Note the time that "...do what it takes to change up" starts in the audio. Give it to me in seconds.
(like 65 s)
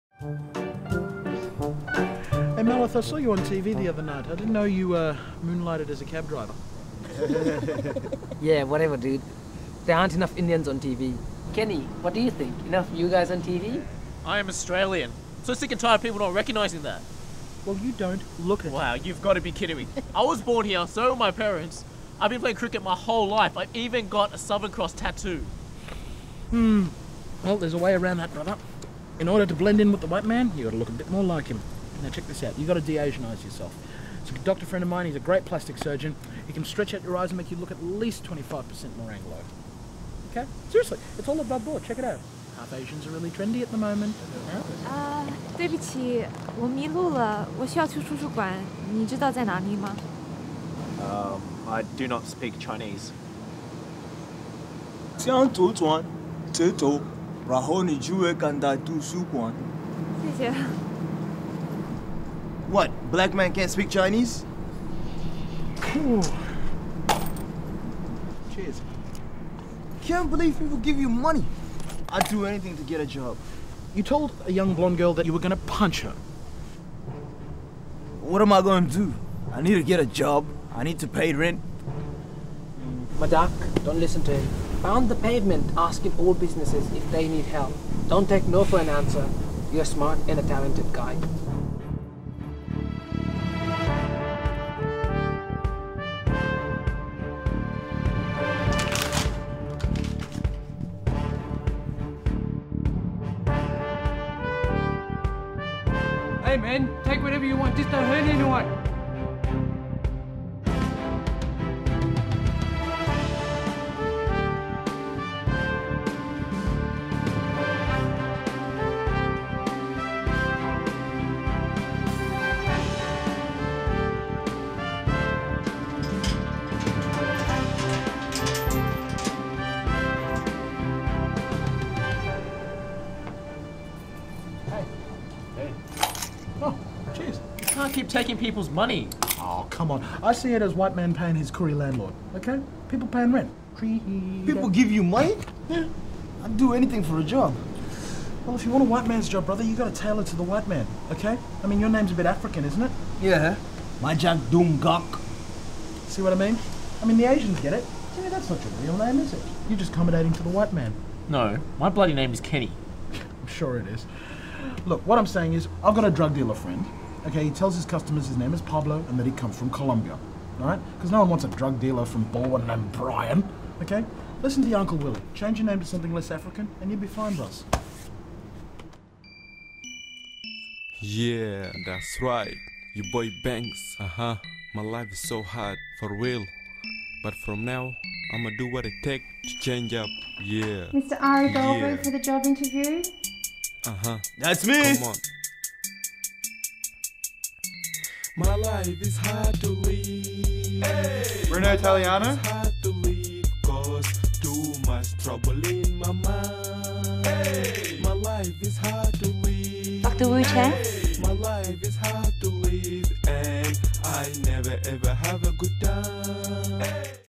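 188 s.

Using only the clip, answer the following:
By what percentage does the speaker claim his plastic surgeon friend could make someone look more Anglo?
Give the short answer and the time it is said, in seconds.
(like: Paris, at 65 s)
25%, at 38 s.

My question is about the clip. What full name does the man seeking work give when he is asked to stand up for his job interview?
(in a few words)
Majak Gok.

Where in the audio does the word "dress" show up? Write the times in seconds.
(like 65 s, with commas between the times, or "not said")
not said.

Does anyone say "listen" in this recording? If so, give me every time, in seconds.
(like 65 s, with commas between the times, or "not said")
83 s, 174 s.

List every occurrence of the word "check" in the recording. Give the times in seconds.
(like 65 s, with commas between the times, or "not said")
32 s, 41 s.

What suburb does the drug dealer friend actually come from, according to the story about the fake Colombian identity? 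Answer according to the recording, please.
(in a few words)
Balwyn.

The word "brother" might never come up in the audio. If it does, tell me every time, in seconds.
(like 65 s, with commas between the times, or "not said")
28 s, 149 s.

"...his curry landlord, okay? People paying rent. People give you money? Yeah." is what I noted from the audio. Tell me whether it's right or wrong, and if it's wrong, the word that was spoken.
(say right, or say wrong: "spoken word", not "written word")
right.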